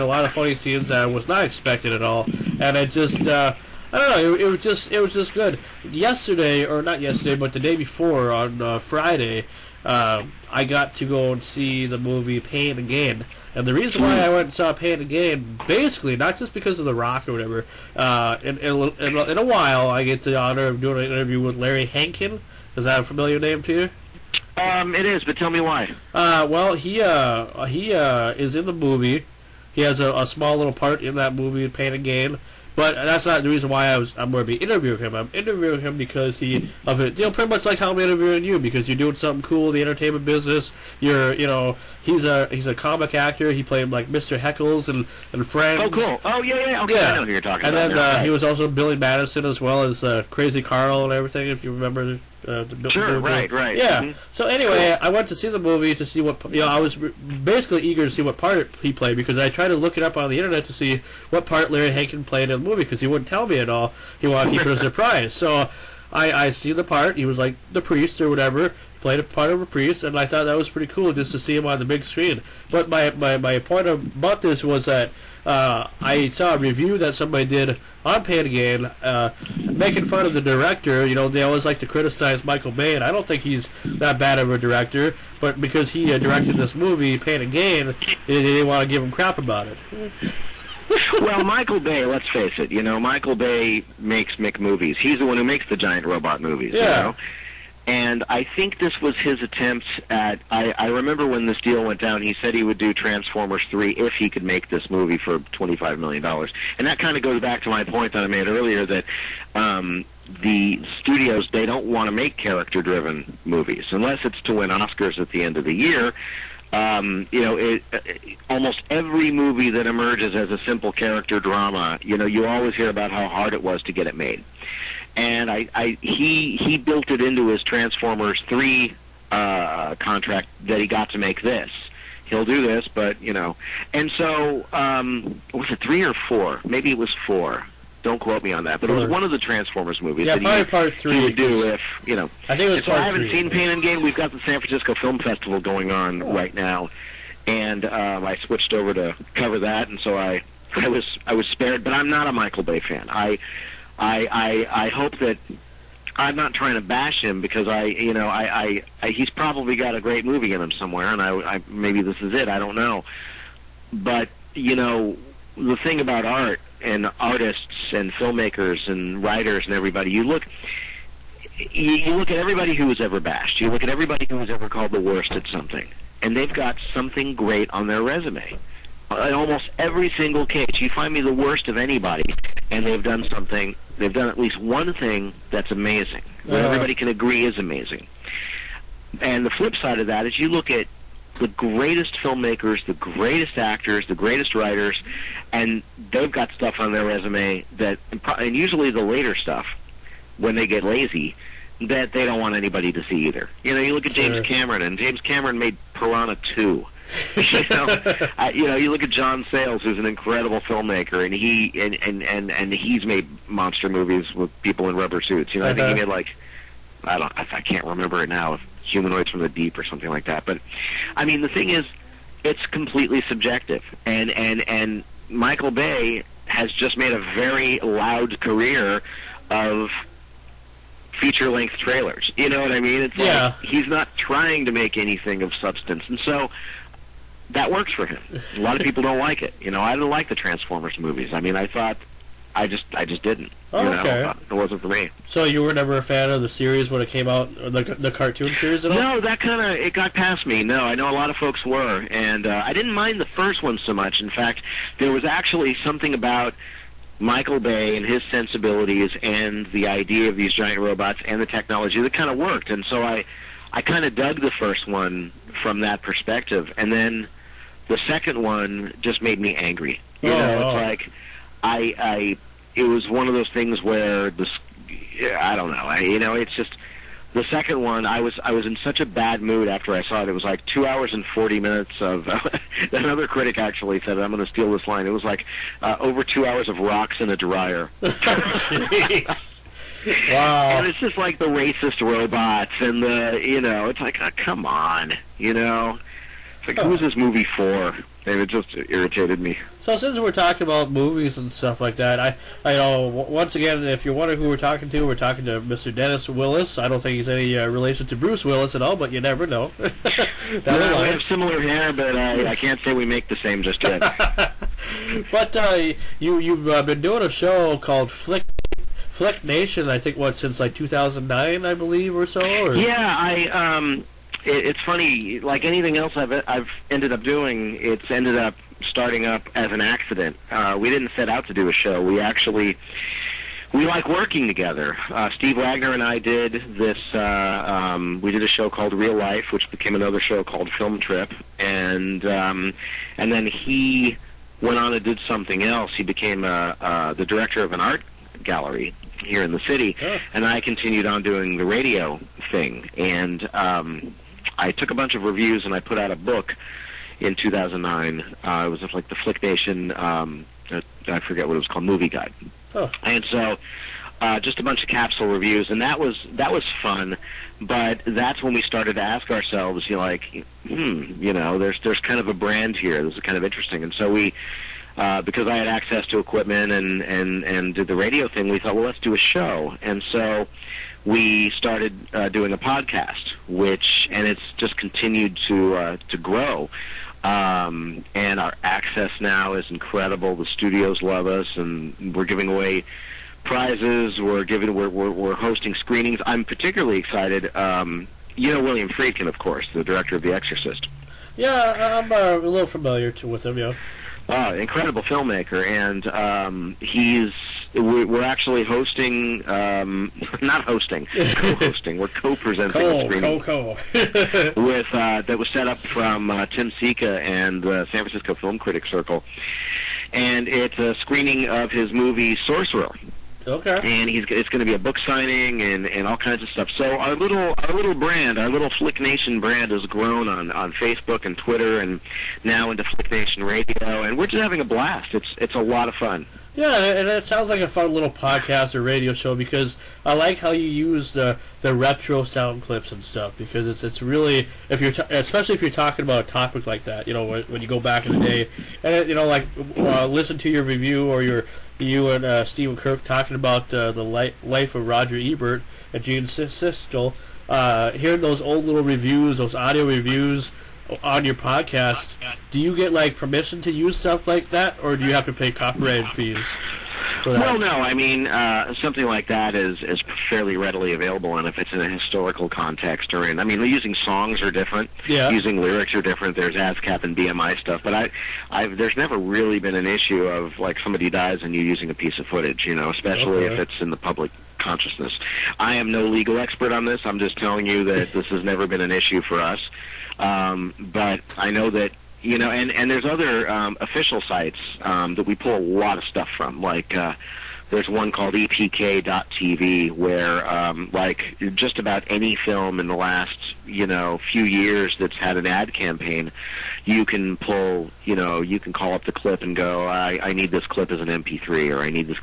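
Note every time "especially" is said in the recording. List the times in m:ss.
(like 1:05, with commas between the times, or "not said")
7:25, 8:02.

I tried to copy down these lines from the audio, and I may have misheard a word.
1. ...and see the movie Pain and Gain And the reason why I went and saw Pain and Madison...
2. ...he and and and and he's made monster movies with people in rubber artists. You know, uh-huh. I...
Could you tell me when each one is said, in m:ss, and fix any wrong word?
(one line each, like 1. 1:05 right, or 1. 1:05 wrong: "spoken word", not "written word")
1. 0:11 wrong: "Gain", not "Madison"
2. 3:31 wrong: "suits", not "artists".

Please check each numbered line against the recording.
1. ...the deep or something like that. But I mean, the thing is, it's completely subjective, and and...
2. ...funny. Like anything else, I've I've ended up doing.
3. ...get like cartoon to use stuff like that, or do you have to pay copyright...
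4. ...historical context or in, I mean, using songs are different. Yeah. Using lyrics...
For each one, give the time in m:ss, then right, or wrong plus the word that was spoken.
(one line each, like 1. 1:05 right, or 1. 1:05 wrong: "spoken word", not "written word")
1. 3:39 right
2. 5:24 right
3. 7:42 wrong: "permission", not "cartoon"
4. 7:51 right.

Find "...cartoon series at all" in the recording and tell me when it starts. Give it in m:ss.
4:08.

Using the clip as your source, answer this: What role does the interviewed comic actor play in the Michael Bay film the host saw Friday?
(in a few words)
A priest.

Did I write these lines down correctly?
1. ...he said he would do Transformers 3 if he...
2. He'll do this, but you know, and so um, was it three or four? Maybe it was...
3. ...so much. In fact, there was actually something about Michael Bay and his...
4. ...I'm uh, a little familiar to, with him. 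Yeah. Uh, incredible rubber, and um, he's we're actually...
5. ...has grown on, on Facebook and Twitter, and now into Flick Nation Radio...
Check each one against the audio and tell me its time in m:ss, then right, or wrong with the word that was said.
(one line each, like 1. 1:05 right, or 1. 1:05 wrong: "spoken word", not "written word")
1. 1:42 right
2. 2:12 right
3. 4:13 right
4. 6:42 wrong: "filmmaker", not "rubber"
5. 7:09 right.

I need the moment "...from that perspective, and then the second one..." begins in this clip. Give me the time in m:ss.
4:25.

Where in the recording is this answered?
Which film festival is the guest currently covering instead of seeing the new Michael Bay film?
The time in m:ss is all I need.
2:24.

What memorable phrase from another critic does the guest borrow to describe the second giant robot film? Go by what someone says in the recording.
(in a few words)
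Rocks in a dryer.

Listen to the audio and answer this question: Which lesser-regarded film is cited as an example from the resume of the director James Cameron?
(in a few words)
Piranha 2.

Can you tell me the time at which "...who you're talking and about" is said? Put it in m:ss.
0:47.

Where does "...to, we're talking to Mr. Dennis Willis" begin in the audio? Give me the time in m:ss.
5:04.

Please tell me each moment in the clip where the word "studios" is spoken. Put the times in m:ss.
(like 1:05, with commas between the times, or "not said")
1:50, 6:30.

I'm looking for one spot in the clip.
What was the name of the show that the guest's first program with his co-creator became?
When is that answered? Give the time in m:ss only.
5:40.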